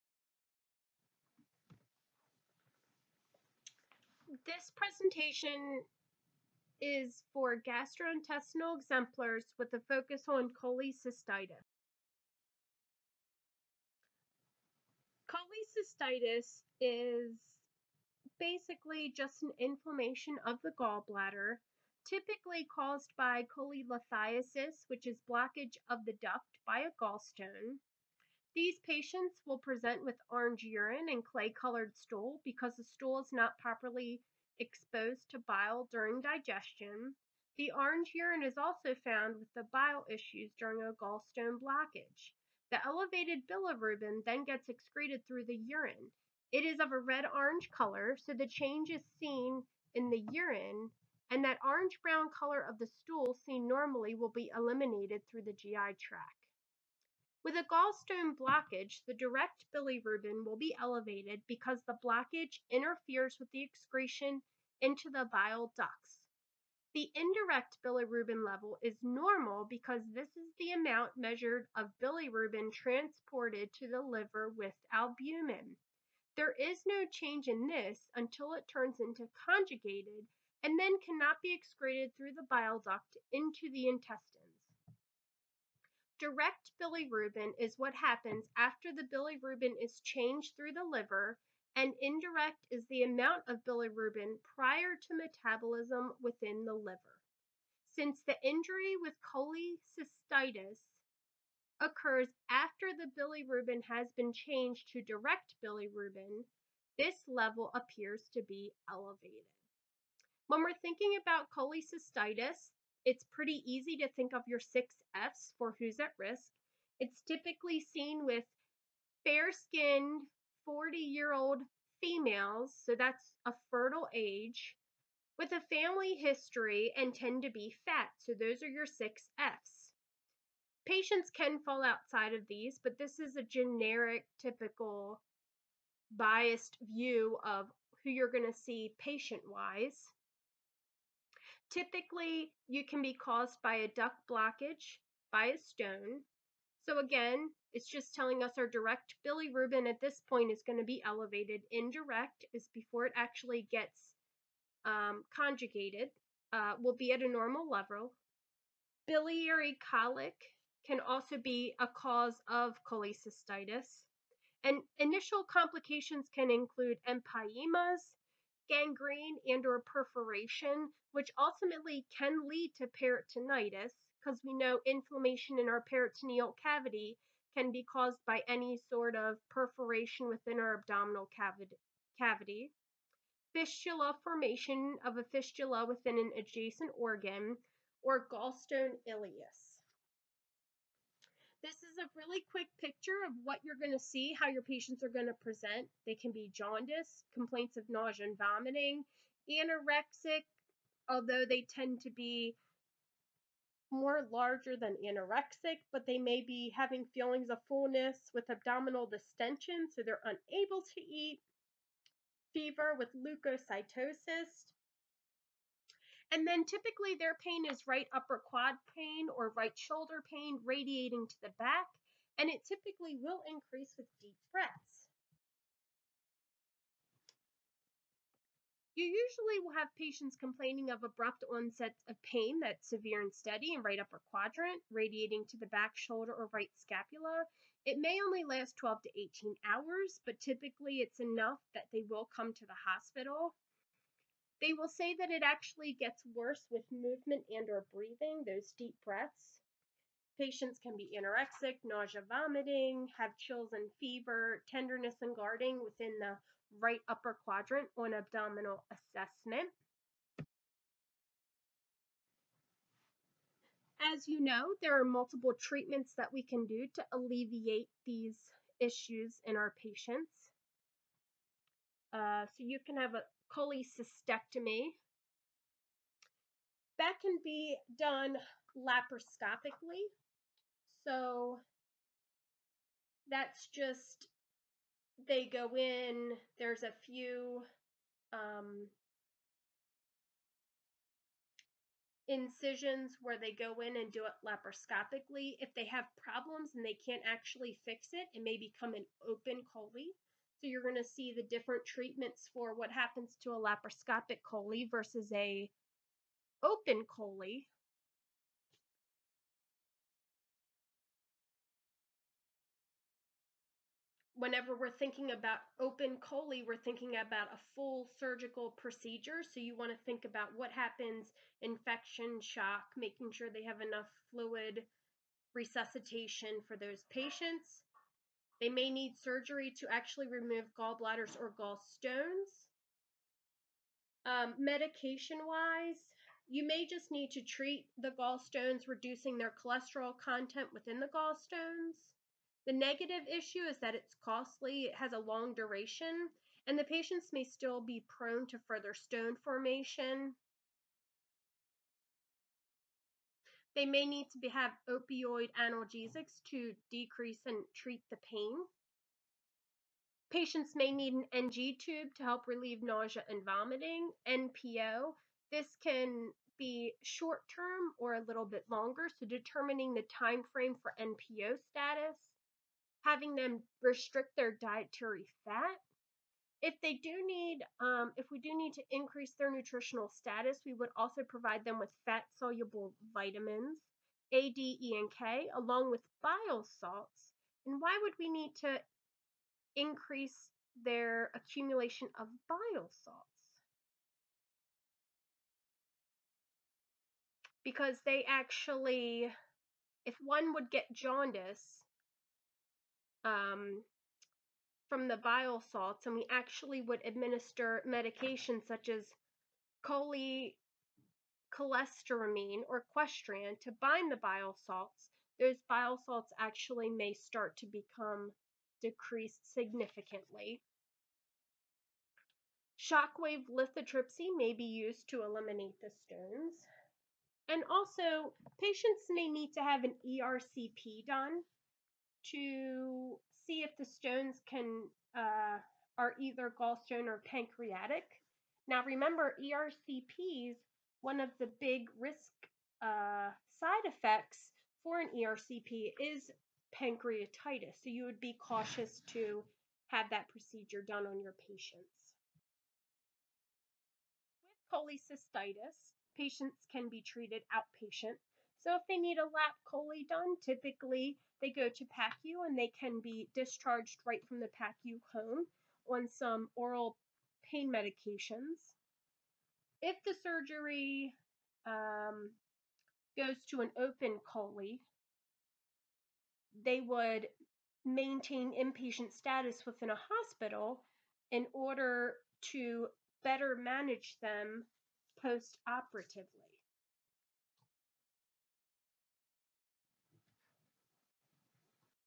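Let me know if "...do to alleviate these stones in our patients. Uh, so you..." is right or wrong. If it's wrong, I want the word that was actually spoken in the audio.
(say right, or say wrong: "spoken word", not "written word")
wrong: "issues", not "stones".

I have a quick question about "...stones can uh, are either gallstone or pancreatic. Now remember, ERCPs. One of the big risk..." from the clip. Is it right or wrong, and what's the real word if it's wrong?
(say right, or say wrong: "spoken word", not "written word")
right.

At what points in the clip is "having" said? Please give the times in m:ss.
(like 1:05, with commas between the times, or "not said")
3:26, 6:13.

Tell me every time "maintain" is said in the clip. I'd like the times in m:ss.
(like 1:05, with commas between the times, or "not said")
7:57.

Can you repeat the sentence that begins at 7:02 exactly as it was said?
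Shockwave lithotripsy may be used to eliminate the stones.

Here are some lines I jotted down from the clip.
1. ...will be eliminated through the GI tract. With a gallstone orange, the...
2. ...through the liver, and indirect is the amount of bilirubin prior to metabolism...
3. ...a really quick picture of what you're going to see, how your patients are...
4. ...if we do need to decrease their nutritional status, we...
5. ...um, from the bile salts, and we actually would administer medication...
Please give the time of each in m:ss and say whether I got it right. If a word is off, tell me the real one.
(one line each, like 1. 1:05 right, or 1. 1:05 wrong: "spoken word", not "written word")
1. 0:54 wrong: "blockage", not "orange"
2. 1:30 right
3. 3:11 right
4. 6:18 wrong: "increase", not "decrease"
5. 6:43 right.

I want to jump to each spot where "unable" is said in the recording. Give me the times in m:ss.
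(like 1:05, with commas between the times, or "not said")
3:30.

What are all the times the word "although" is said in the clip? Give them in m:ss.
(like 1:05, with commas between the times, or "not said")
3:21.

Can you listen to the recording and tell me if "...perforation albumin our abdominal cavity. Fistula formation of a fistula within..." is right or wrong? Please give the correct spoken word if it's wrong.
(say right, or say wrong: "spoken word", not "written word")
wrong: "within", not "albumin".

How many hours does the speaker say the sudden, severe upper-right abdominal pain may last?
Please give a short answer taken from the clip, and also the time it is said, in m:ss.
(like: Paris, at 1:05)
12 to 18 hours, at 3:58.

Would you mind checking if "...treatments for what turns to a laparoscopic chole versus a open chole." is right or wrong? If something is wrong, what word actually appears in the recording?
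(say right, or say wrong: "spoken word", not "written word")
wrong: "happens", not "turns".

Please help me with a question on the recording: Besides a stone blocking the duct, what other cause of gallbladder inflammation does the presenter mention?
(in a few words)
Biliary colic.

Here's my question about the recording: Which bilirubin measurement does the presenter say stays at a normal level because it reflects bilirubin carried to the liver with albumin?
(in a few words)
indirect bilirubin.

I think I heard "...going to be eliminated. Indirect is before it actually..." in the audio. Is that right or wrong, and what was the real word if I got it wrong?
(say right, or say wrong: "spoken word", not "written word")
wrong: "elevated", not "eliminated".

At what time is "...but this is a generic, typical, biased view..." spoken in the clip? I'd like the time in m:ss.
2:12.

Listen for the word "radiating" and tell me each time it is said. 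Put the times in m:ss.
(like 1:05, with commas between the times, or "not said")
3:40, 3:54.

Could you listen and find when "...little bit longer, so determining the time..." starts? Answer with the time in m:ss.
6:08.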